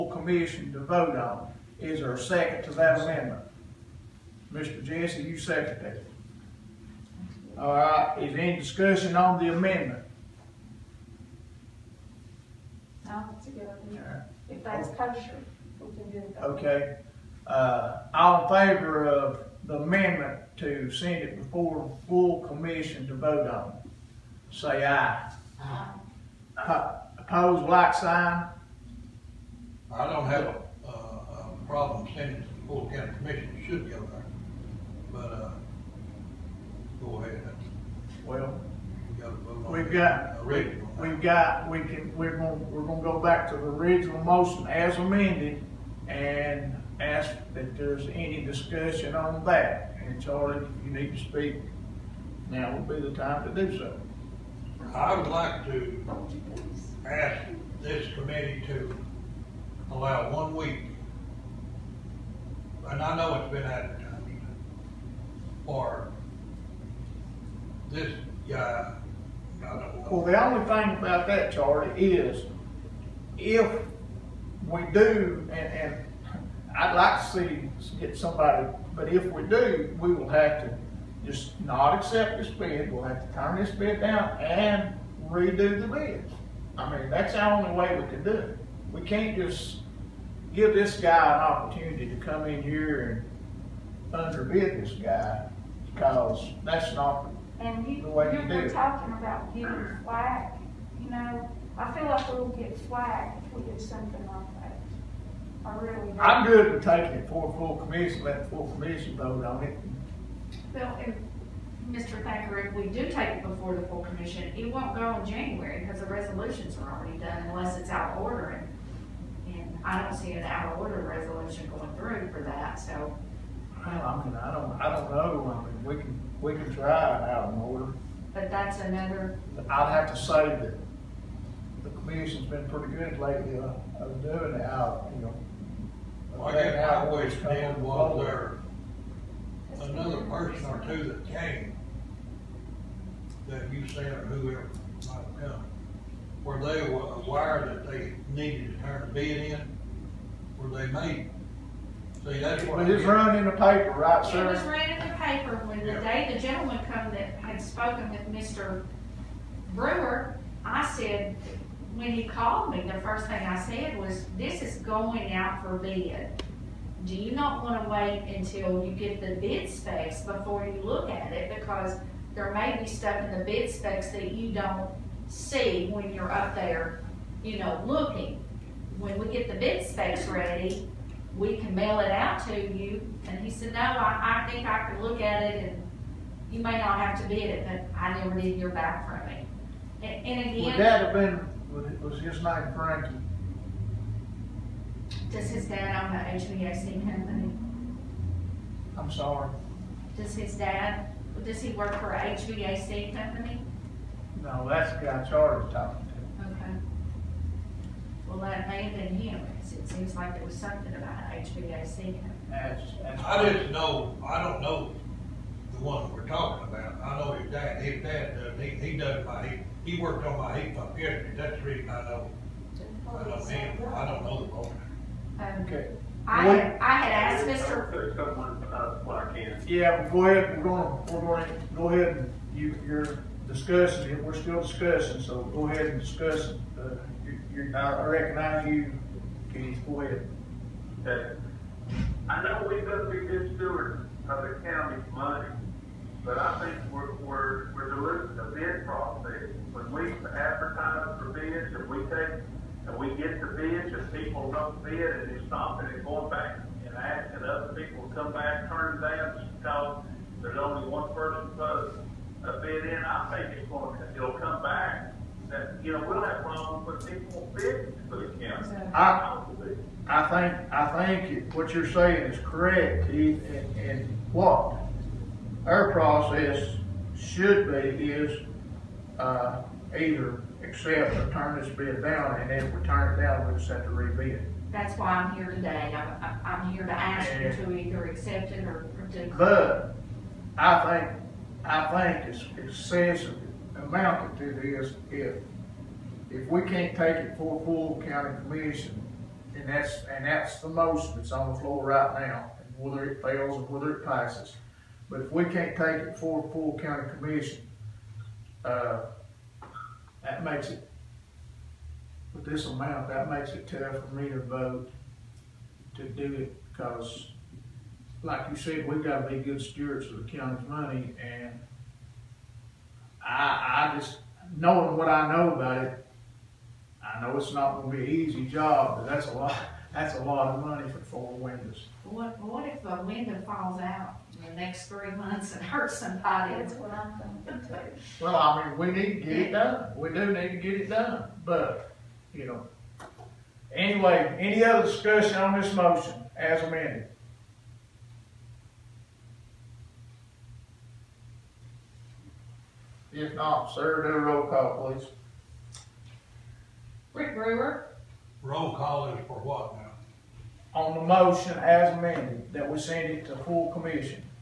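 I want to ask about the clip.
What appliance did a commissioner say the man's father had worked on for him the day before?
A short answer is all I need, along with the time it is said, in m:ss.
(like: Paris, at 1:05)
Heat pump, at 3:40.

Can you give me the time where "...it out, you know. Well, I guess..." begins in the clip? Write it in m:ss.
2:14.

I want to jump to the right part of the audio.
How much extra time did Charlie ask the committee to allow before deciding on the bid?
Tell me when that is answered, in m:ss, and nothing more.
1:00.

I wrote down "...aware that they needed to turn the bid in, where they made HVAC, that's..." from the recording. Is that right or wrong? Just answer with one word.
wrong.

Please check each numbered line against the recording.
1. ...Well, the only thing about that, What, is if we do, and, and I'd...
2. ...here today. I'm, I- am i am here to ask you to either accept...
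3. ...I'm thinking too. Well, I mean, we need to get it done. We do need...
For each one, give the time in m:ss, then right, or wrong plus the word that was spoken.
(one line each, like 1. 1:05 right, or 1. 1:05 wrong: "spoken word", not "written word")
1. 1:10 wrong: "Charlie", not "What"
2. 4:45 right
3. 5:36 right.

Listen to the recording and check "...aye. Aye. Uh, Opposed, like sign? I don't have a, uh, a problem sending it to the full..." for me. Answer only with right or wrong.
right.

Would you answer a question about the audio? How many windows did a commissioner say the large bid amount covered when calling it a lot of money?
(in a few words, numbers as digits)
4.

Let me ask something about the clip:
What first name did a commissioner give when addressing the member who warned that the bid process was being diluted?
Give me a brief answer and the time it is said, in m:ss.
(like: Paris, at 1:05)
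Keith, at 4:33.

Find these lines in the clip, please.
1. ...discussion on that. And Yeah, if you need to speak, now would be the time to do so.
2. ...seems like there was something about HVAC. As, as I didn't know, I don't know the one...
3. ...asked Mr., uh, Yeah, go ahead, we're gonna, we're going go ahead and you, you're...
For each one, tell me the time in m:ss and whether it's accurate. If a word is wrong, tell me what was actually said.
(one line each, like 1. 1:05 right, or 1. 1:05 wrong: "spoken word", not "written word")
1. 0:48 wrong: "Charlie", not "Yeah"
2. 3:29 right
3. 3:47 right.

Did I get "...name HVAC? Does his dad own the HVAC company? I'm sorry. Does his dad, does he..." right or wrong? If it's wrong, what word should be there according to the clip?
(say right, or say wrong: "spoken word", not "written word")
wrong: "Frankie", not "HVAC".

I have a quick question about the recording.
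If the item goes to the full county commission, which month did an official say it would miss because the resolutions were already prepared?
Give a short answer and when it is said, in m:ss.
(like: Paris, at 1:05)
January, at 1:55.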